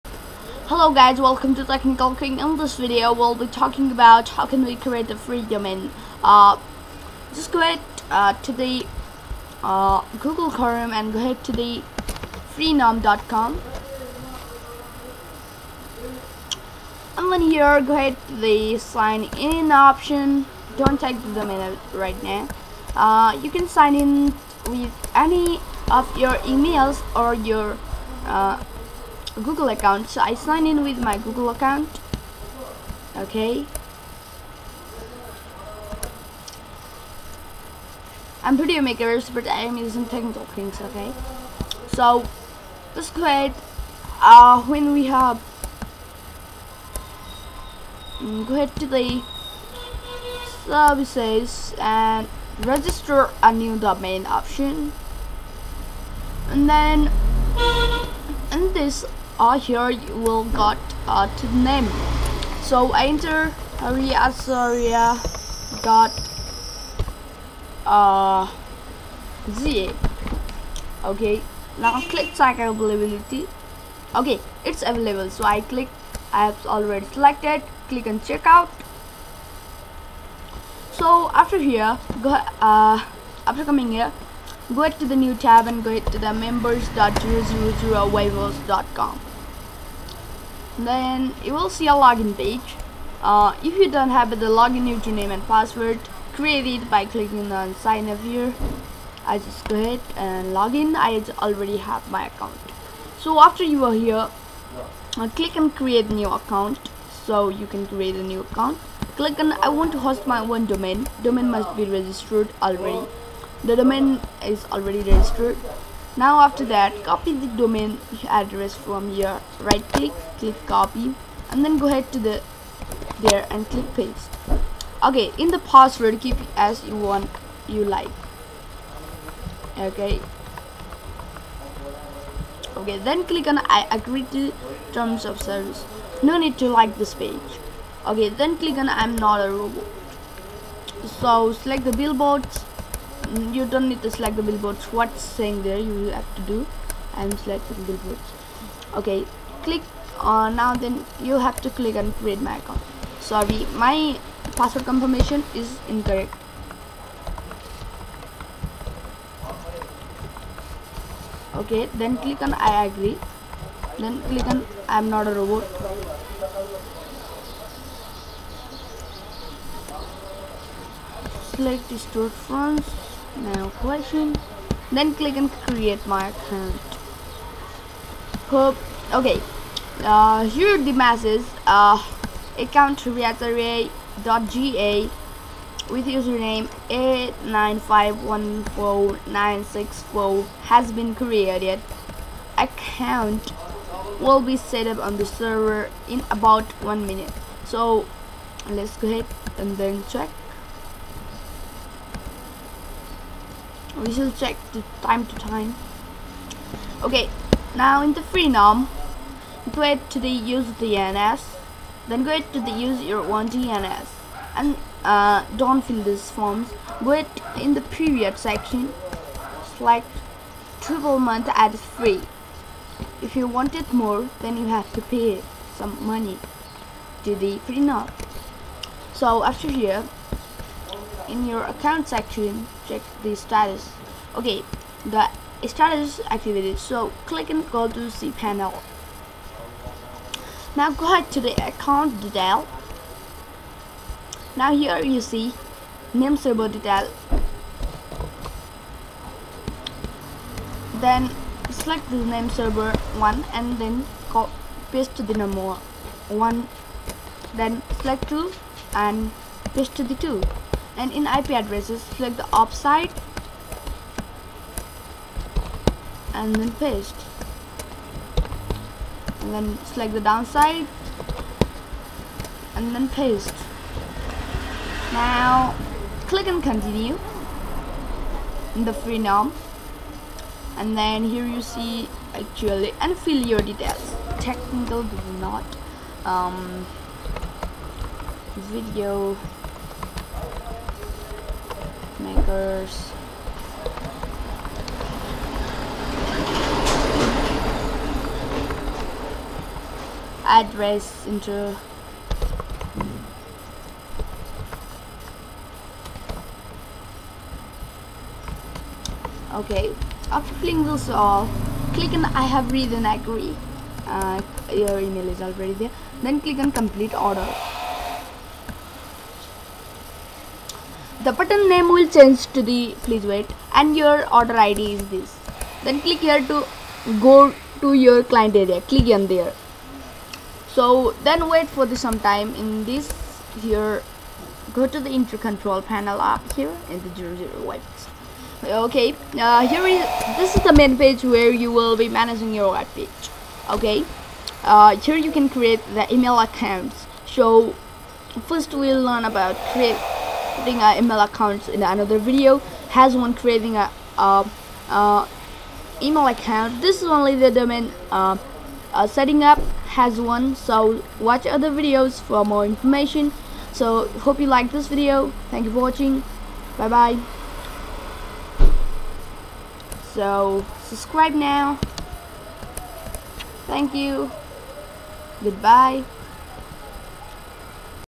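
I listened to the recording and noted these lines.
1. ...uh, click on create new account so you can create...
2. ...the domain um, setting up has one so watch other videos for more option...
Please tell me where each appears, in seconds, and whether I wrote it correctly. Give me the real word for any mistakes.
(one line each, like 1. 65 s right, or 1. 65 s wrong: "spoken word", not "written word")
1. 105 s right
2. 357 s wrong: "information", not "option".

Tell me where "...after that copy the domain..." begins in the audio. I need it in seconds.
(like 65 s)
116 s.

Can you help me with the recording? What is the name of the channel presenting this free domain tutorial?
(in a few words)
Technical King.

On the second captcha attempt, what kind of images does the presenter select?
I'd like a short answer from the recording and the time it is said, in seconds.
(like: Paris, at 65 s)
storefronts, at 171 s.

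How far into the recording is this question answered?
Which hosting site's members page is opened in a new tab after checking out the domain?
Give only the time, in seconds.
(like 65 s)
86 s.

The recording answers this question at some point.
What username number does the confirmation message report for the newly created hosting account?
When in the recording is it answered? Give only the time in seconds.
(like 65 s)
186 s.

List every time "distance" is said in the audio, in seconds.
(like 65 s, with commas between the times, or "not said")
not said.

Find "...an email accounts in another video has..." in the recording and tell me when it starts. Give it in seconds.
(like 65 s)
350 s.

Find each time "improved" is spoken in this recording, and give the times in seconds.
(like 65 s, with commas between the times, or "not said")
not said.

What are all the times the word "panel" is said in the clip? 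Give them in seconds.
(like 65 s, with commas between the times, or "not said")
238 s, 335 s.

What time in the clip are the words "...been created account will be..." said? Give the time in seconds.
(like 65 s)
190 s.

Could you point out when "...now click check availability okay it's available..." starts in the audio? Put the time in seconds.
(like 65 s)
71 s.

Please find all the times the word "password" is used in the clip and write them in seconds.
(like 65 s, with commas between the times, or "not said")
95 s, 125 s, 154 s.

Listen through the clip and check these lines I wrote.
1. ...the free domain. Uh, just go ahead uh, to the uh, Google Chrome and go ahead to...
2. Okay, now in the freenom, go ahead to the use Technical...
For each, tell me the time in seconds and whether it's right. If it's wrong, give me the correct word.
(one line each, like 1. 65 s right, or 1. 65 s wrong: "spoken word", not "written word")
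1. 5 s right
2. 207 s wrong: "DNS", not "Technical".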